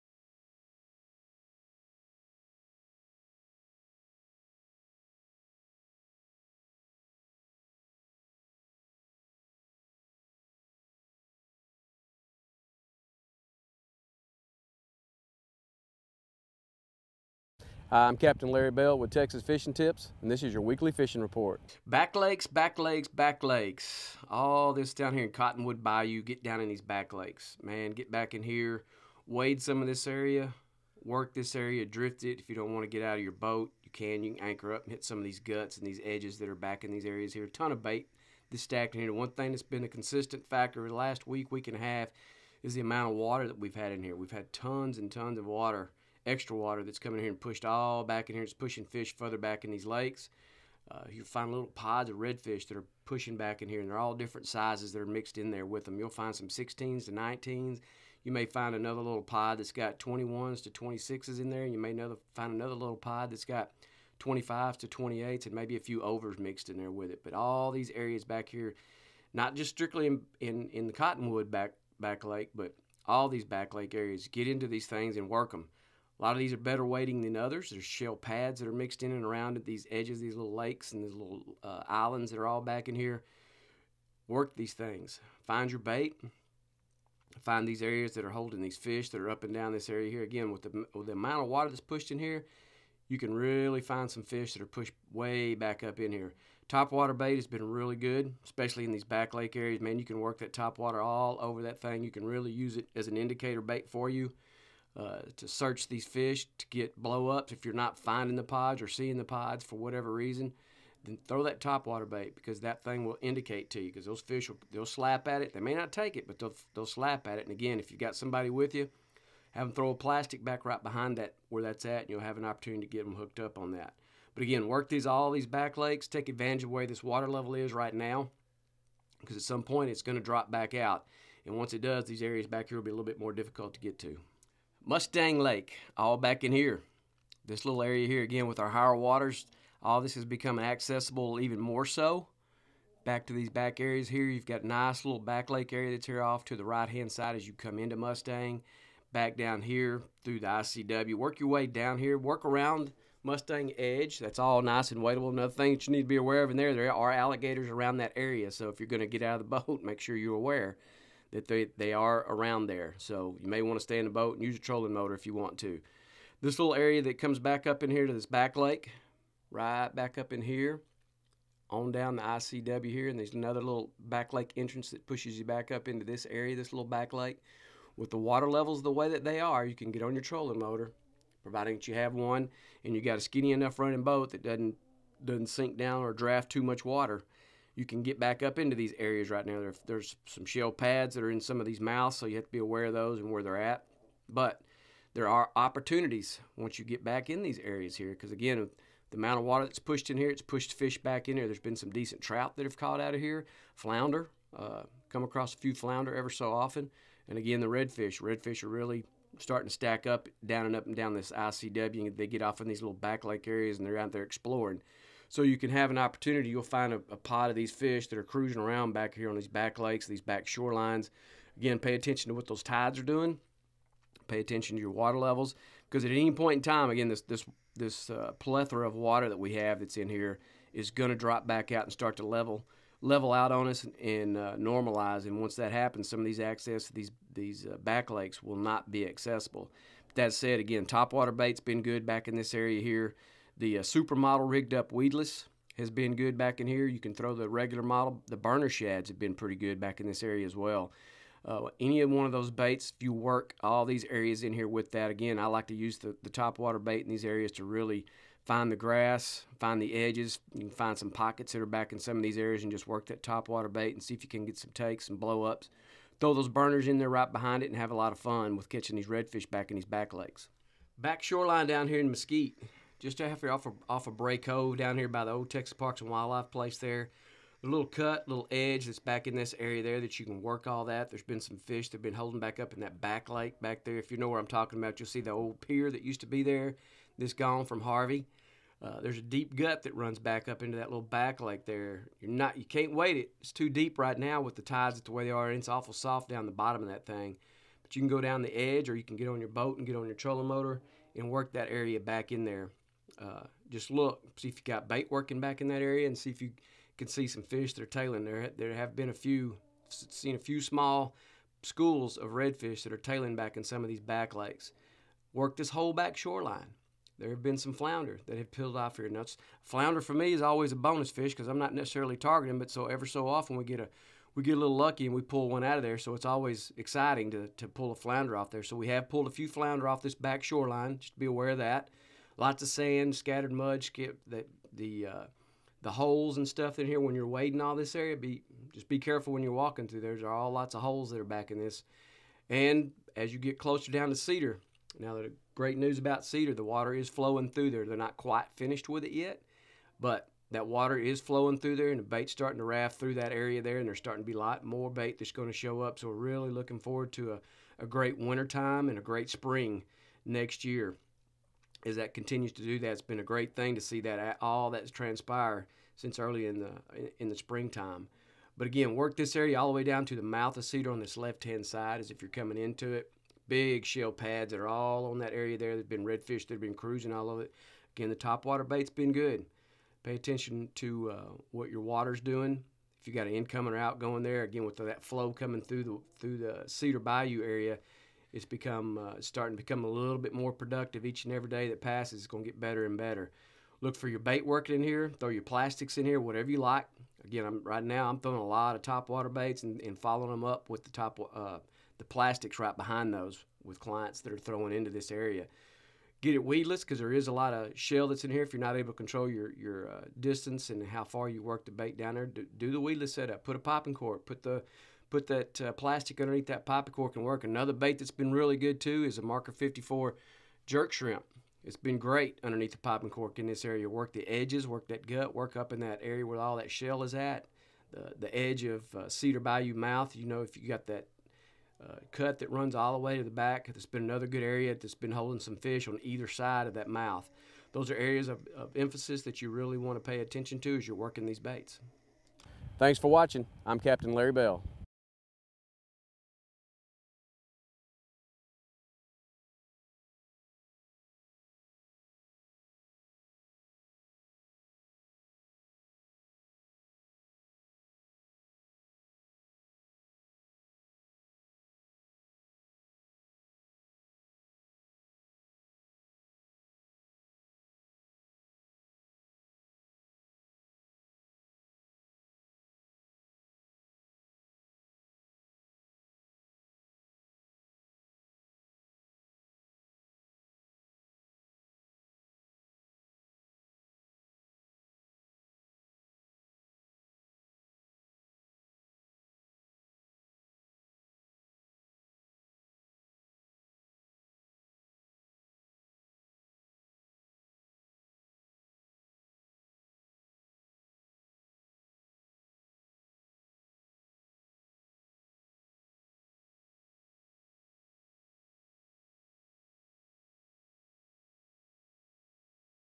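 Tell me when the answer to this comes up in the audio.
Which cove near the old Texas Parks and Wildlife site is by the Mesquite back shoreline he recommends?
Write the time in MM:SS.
04:34.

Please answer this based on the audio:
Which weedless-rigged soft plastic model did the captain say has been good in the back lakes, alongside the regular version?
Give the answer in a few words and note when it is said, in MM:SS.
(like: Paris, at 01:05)
Supermodel, at 04:03.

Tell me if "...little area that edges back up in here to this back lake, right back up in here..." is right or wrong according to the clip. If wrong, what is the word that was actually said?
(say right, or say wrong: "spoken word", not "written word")
wrong: "comes", not "edges".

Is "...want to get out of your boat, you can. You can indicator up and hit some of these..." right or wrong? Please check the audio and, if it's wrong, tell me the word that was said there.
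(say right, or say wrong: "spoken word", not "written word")
wrong: "anchor", not "indicator".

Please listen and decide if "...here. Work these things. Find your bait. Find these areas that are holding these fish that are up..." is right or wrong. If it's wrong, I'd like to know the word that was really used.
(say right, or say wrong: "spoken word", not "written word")
right.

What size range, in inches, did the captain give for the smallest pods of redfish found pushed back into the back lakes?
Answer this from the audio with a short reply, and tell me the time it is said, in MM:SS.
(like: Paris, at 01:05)
16 to 19, at 00:56.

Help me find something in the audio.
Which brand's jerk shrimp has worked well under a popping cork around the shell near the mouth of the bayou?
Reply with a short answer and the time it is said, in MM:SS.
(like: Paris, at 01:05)
Marker 54, at 06:59.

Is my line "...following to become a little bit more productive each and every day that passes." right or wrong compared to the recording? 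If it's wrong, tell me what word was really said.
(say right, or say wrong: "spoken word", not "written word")
wrong: "starting", not "following".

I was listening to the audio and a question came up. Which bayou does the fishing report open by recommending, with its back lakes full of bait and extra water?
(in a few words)
Cottonwood Bayou.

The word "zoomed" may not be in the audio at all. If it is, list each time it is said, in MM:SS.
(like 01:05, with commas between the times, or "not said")
not said.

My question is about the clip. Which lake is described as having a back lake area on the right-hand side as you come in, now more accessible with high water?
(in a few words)
Mustang Lake.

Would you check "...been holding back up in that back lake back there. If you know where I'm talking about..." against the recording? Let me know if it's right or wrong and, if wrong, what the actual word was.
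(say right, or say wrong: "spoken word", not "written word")
right.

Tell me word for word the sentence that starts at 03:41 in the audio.
Again, pay attention to what those tides are doing.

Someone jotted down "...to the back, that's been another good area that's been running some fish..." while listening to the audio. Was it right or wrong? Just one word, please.
wrong.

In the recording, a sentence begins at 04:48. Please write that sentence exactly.
Uh, there's a deep gut that runs back up into that little back lake there.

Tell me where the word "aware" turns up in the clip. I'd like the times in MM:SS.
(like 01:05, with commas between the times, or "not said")
02:36, 02:40, 03:12, 05:31.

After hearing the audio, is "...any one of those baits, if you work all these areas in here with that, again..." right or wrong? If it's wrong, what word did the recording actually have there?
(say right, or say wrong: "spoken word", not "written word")
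right.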